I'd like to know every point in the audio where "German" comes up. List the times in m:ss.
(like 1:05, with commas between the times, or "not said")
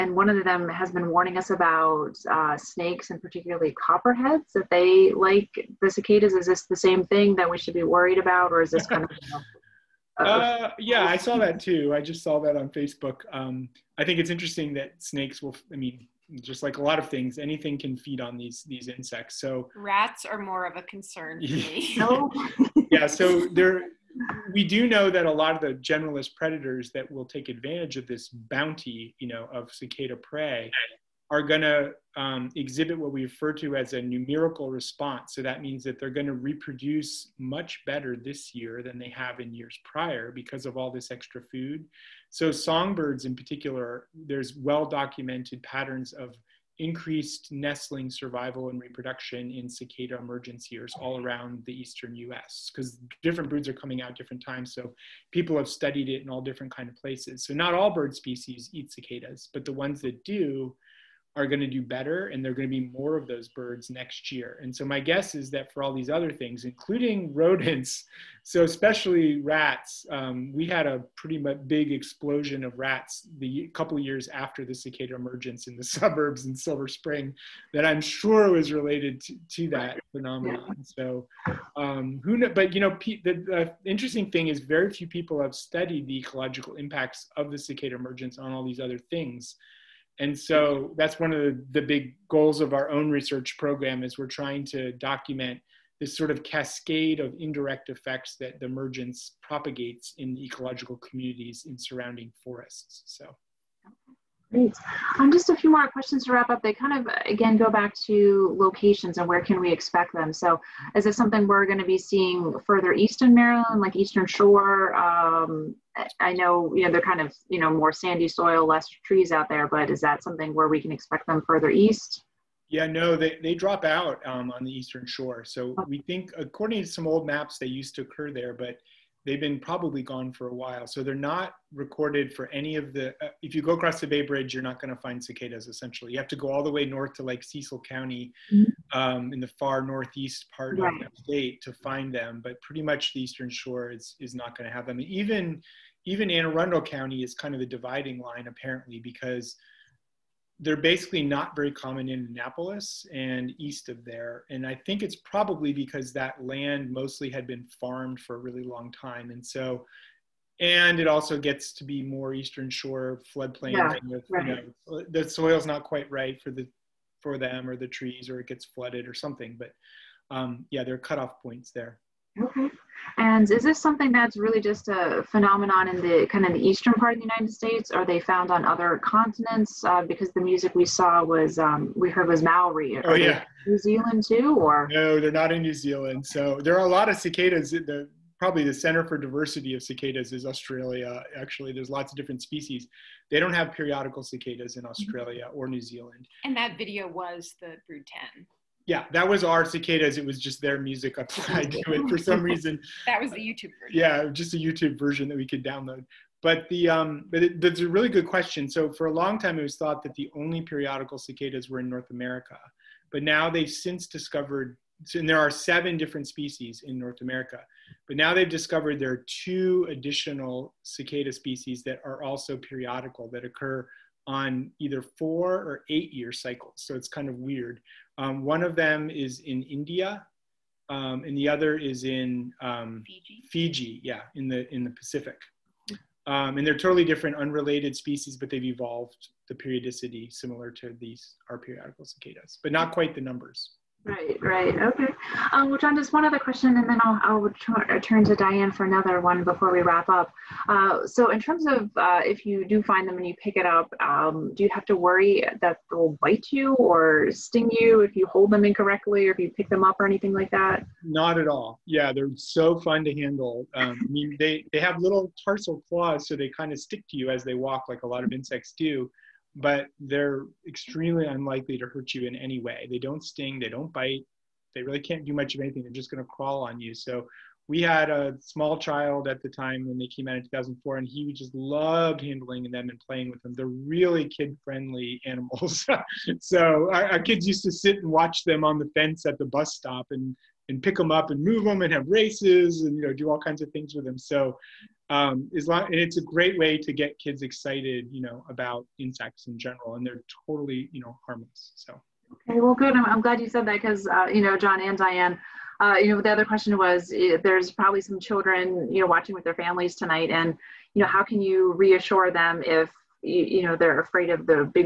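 not said.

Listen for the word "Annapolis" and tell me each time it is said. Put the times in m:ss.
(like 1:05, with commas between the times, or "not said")
2:32.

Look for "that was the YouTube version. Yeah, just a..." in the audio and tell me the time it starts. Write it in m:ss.
3:23.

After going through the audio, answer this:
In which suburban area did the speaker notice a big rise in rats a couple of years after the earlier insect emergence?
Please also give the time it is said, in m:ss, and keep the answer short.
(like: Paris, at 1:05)
Silver Spring, at 1:16.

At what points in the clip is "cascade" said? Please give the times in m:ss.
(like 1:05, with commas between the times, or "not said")
1:36.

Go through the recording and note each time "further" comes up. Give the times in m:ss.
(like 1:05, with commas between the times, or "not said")
1:52, 2:01.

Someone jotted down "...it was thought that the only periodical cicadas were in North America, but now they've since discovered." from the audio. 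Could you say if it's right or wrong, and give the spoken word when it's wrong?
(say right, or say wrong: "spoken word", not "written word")
right.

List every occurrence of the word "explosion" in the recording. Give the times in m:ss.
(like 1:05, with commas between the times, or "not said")
1:11.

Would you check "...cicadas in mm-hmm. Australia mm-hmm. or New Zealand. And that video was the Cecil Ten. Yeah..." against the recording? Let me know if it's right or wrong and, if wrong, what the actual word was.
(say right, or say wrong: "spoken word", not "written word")
wrong: "Brood", not "Cecil".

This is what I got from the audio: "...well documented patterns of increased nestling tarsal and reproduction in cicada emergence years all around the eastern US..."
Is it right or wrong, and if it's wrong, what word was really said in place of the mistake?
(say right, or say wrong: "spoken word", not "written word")
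wrong: "survival", not "tarsal".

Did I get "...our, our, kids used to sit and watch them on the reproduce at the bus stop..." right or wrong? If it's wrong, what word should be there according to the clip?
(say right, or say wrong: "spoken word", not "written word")
wrong: "fence", not "reproduce".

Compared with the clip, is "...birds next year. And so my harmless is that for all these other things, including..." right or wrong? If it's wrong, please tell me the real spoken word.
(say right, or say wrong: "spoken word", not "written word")
wrong: "guess", not "harmless".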